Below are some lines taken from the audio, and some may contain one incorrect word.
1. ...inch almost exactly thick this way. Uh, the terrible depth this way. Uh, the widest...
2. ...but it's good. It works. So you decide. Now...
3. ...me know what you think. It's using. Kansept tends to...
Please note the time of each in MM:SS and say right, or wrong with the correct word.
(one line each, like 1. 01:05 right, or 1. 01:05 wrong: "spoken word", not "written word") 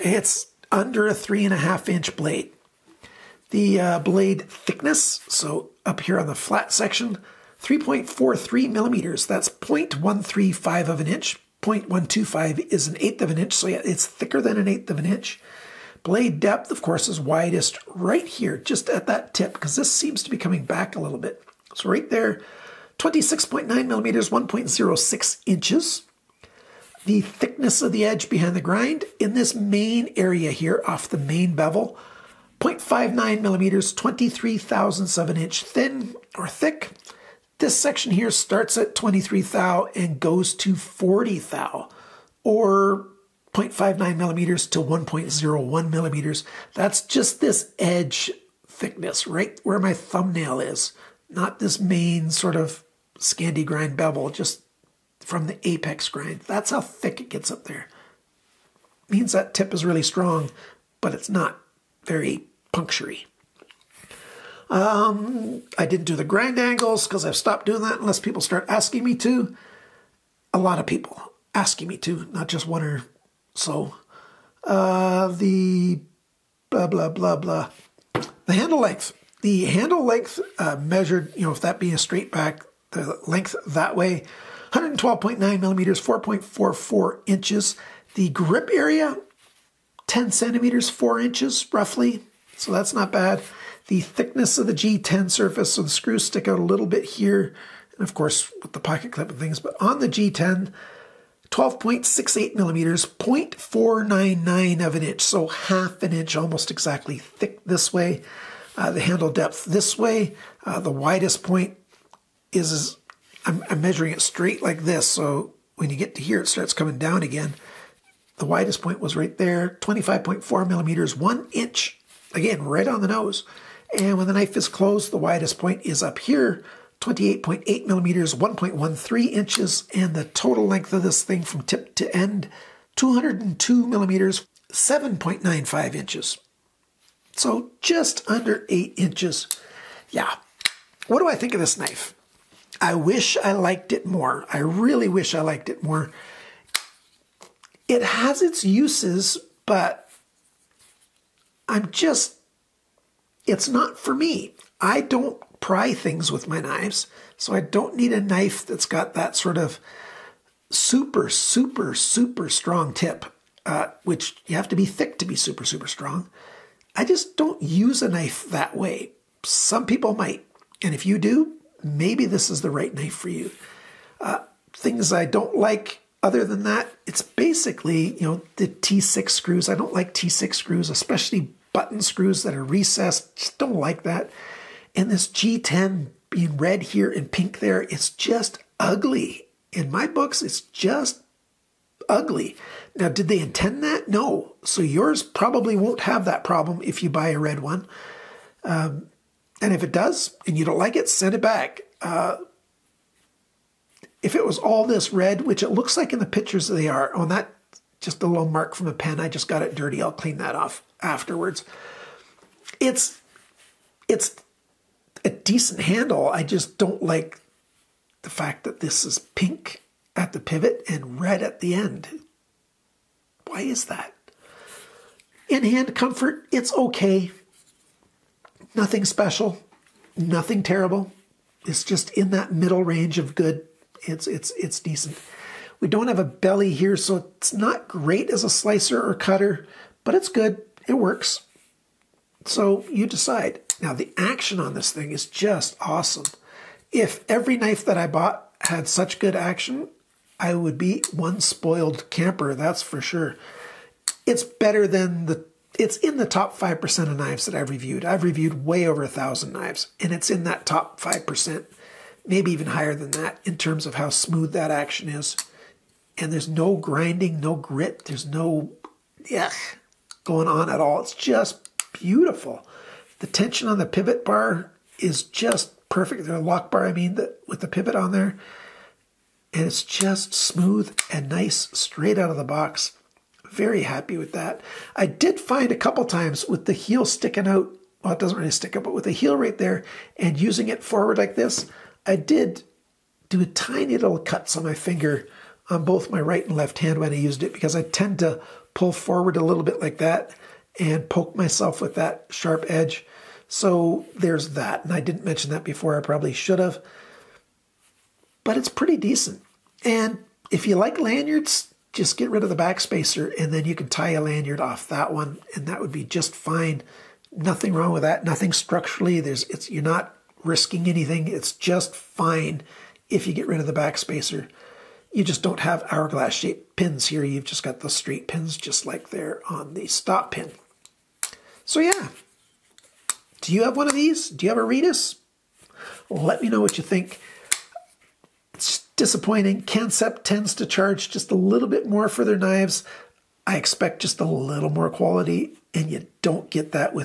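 1. 01:46 wrong: "handle", not "terrible"
2. 04:00 right
3. 05:36 wrong: "disappointing", not "using".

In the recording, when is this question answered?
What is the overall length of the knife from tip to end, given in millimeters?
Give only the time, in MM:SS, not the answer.
02:12.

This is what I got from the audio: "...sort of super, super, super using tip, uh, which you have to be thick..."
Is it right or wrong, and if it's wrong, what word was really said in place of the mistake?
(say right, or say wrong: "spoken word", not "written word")
wrong: "strong", not "using".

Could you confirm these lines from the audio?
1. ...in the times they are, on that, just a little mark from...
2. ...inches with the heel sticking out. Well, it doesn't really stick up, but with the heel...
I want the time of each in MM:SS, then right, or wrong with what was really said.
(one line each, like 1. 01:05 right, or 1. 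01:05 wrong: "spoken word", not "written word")
1. 03:26 wrong: "pictures", not "times"
2. 04:46 wrong: "times", not "inches".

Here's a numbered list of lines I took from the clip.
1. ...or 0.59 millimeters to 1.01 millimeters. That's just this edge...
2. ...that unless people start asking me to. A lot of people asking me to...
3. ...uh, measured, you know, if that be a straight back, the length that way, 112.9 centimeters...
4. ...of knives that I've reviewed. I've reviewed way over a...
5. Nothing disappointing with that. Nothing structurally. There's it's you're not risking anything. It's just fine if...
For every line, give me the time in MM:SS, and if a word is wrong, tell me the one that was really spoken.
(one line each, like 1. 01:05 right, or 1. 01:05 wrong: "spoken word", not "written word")
1. 00:42 right
2. 01:07 right
3. 01:20 wrong: "millimeters", not "centimeters"
4. 04:17 right
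5. 05:17 wrong: "wrong", not "disappointing".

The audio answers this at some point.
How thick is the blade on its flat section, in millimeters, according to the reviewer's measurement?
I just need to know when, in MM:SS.
00:07.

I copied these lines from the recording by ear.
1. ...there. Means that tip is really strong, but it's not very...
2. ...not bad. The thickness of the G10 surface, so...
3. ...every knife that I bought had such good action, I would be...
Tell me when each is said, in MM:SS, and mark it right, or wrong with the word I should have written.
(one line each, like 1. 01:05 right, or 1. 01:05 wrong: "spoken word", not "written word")
1. 00:57 right
2. 01:32 right
3. 04:07 right.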